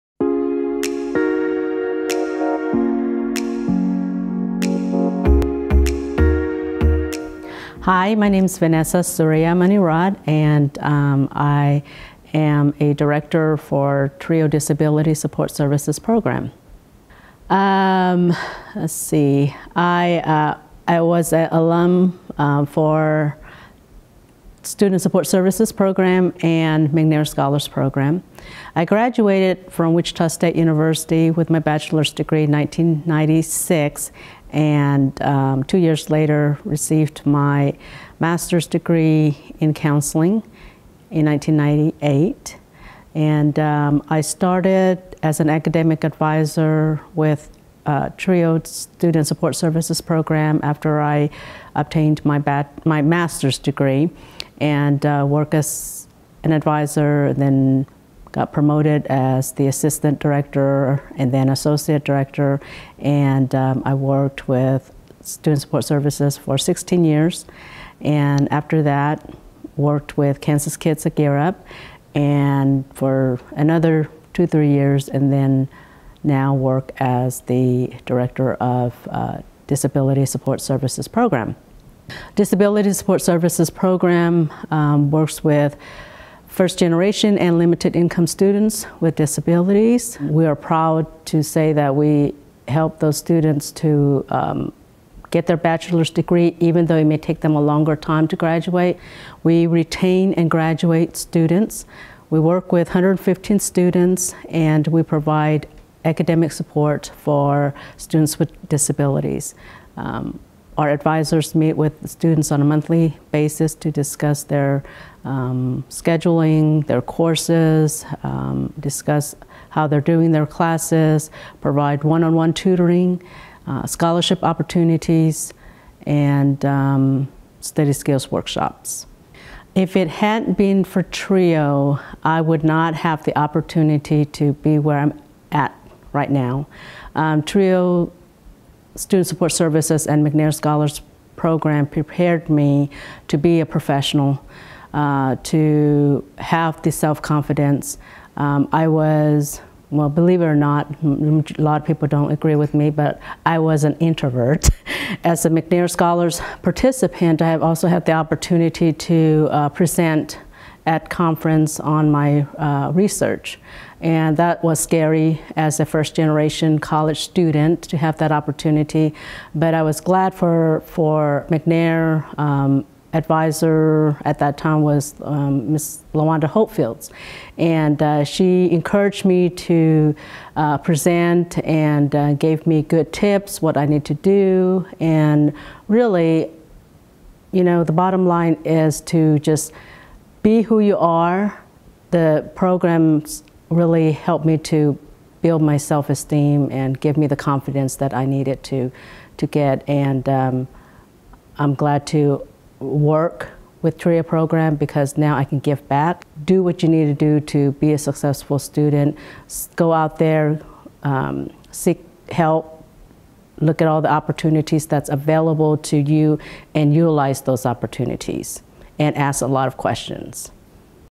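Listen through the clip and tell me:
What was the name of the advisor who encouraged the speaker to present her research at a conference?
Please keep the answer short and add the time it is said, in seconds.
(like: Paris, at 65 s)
Lawanda Hopefields, at 176 s.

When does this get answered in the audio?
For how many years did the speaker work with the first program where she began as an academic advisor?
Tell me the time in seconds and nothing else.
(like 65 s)
66 s.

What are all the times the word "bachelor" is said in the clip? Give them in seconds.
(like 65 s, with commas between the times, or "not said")
31 s, 95 s.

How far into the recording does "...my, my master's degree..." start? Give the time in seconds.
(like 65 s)
52 s.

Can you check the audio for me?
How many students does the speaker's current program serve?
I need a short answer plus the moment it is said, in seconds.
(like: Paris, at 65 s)
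115, at 102 s.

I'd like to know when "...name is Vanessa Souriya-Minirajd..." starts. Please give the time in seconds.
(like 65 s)
8 s.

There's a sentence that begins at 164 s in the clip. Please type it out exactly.
And that was scary as a first generation college student to have that opportunity.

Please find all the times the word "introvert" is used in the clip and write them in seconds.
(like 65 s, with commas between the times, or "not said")
153 s.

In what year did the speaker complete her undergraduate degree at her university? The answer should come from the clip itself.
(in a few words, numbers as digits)
1996.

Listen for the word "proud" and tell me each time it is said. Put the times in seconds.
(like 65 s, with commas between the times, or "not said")
90 s.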